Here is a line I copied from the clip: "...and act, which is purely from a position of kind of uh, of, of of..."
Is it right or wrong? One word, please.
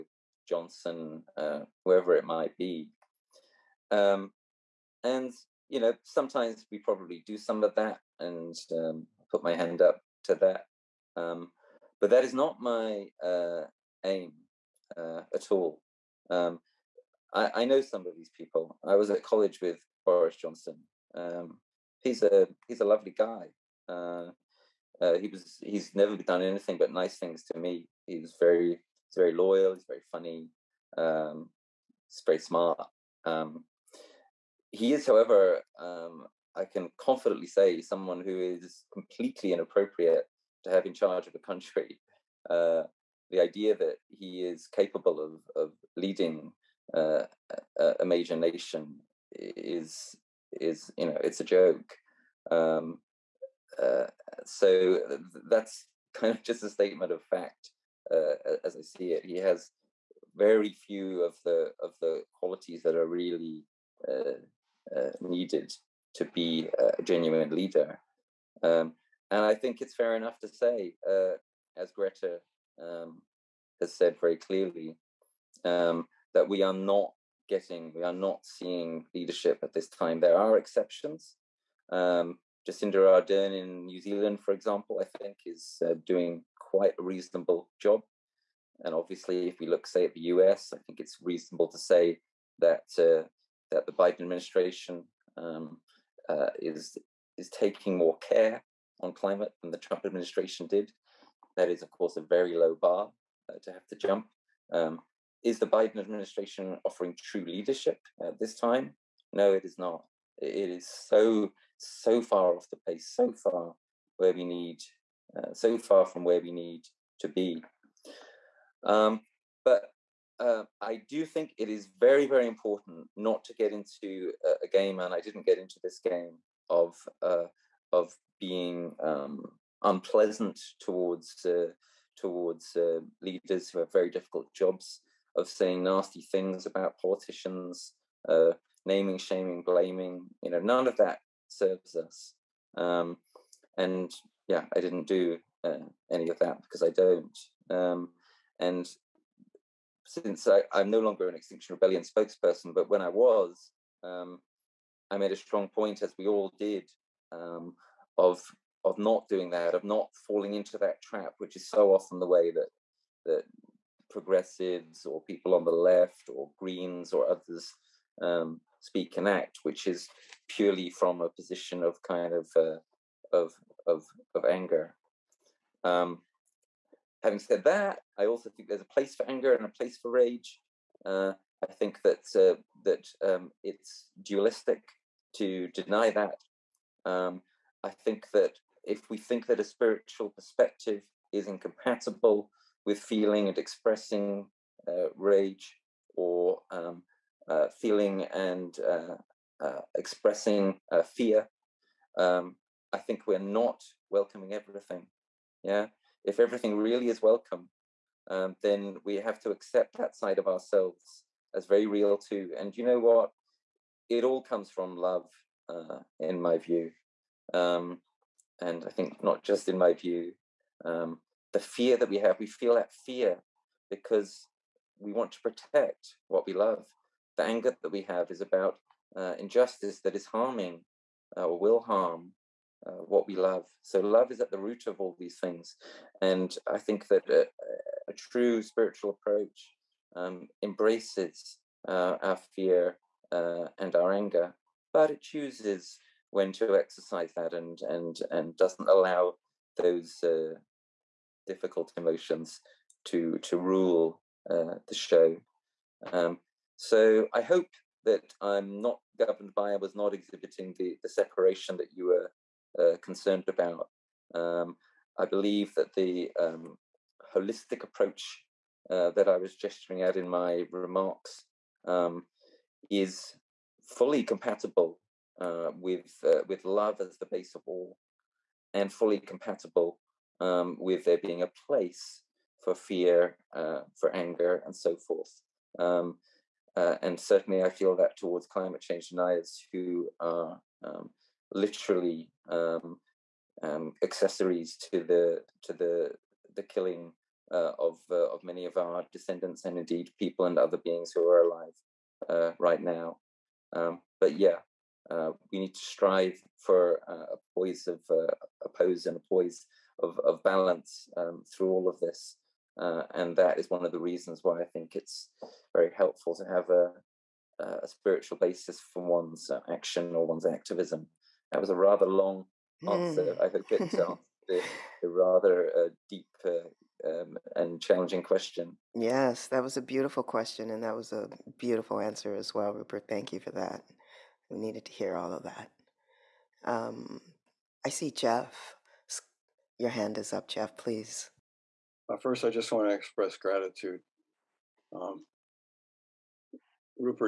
right.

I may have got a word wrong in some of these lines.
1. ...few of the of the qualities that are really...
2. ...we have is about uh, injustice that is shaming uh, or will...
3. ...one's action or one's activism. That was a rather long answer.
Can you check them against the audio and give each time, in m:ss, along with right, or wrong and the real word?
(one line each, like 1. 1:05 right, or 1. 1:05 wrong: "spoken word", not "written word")
1. 1:00 right
2. 3:47 wrong: "harming", not "shaming"
3. 5:19 right.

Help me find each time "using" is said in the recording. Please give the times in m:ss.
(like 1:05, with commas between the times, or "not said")
not said.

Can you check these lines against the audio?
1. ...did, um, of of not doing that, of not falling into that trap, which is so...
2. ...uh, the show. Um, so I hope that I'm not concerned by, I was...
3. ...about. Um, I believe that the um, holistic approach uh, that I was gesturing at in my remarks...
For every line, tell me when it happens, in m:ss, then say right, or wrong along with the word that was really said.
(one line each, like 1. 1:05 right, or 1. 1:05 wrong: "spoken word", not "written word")
1. 2:36 right
2. 4:14 wrong: "governed", not "concerned"
3. 4:23 right.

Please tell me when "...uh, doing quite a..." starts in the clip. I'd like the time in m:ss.
1:25.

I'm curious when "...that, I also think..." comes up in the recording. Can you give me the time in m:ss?
2:57.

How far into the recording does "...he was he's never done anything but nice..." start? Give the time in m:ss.
0:25.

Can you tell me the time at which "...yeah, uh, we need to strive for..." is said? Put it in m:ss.
5:04.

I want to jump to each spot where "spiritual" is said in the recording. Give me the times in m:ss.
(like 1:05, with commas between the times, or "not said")
3:09, 3:58, 5:17.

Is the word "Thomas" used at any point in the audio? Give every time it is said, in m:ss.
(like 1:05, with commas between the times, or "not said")
not said.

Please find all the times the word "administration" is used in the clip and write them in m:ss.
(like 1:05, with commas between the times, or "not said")
1:34, 1:40, 1:45.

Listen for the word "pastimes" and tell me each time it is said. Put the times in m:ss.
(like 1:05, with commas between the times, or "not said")
not said.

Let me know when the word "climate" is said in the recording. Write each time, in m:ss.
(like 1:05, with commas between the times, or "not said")
1:39, 4:48.